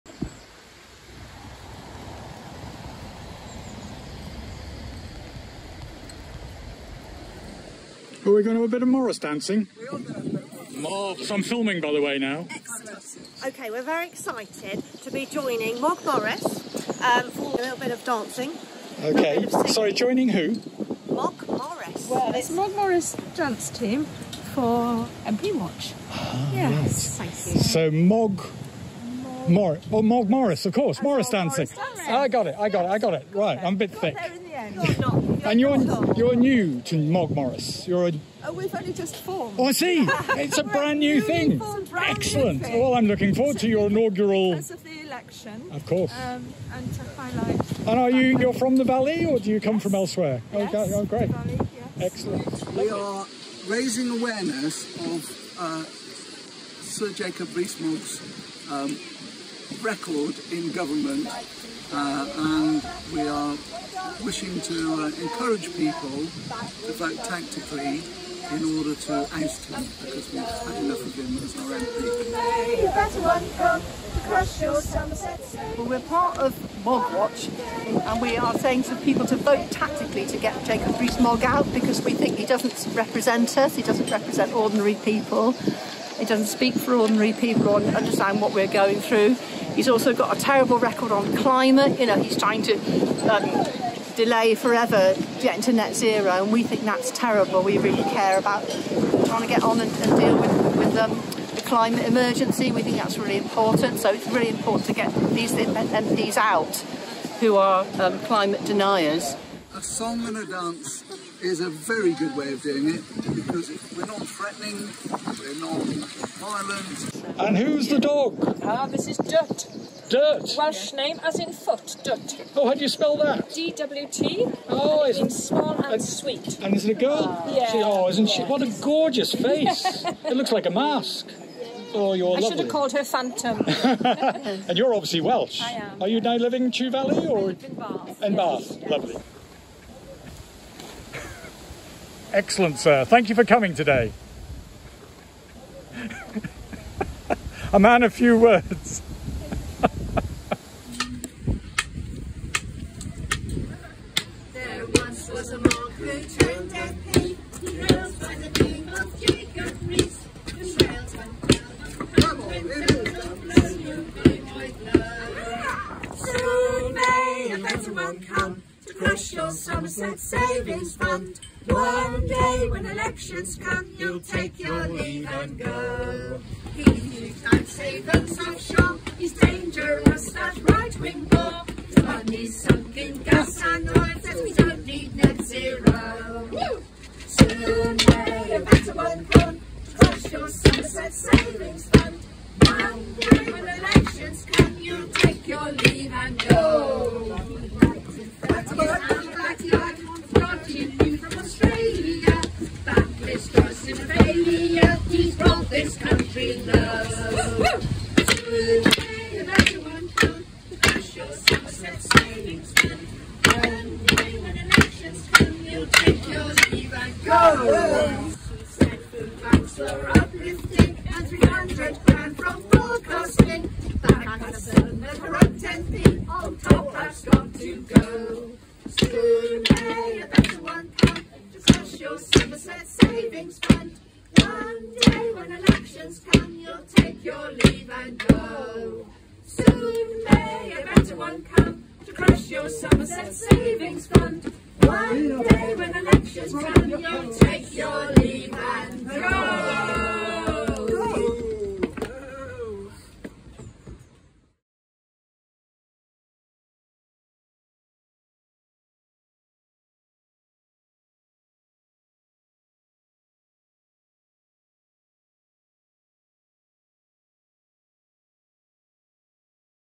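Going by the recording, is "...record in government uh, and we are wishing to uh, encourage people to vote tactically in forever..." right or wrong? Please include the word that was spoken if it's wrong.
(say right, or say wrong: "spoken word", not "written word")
wrong: "order", not "forever".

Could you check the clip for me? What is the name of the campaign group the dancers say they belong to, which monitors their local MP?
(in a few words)
Mog Watch.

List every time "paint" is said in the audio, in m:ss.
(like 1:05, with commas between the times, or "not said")
not said.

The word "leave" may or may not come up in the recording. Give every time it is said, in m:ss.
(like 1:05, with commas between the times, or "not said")
2:54, 3:15, 3:57, 4:08.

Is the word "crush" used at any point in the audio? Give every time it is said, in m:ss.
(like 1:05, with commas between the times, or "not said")
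3:09, 4:02.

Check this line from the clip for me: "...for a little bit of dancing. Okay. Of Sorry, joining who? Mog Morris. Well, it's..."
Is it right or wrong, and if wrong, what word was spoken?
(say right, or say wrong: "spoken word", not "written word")
right.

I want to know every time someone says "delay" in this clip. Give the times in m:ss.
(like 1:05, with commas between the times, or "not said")
1:34.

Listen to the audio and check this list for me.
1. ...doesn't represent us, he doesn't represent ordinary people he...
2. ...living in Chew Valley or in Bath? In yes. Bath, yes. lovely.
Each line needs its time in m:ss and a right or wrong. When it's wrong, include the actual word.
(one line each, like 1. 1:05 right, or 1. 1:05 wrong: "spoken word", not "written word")
1. 1:22 right
2. 2:16 right.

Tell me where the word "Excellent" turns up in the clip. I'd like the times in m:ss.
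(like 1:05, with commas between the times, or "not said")
0:12, 0:42, 0:52, 2:22.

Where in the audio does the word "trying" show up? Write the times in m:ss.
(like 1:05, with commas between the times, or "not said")
1:32, 1:39.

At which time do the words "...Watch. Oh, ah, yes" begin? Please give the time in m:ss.
0:25.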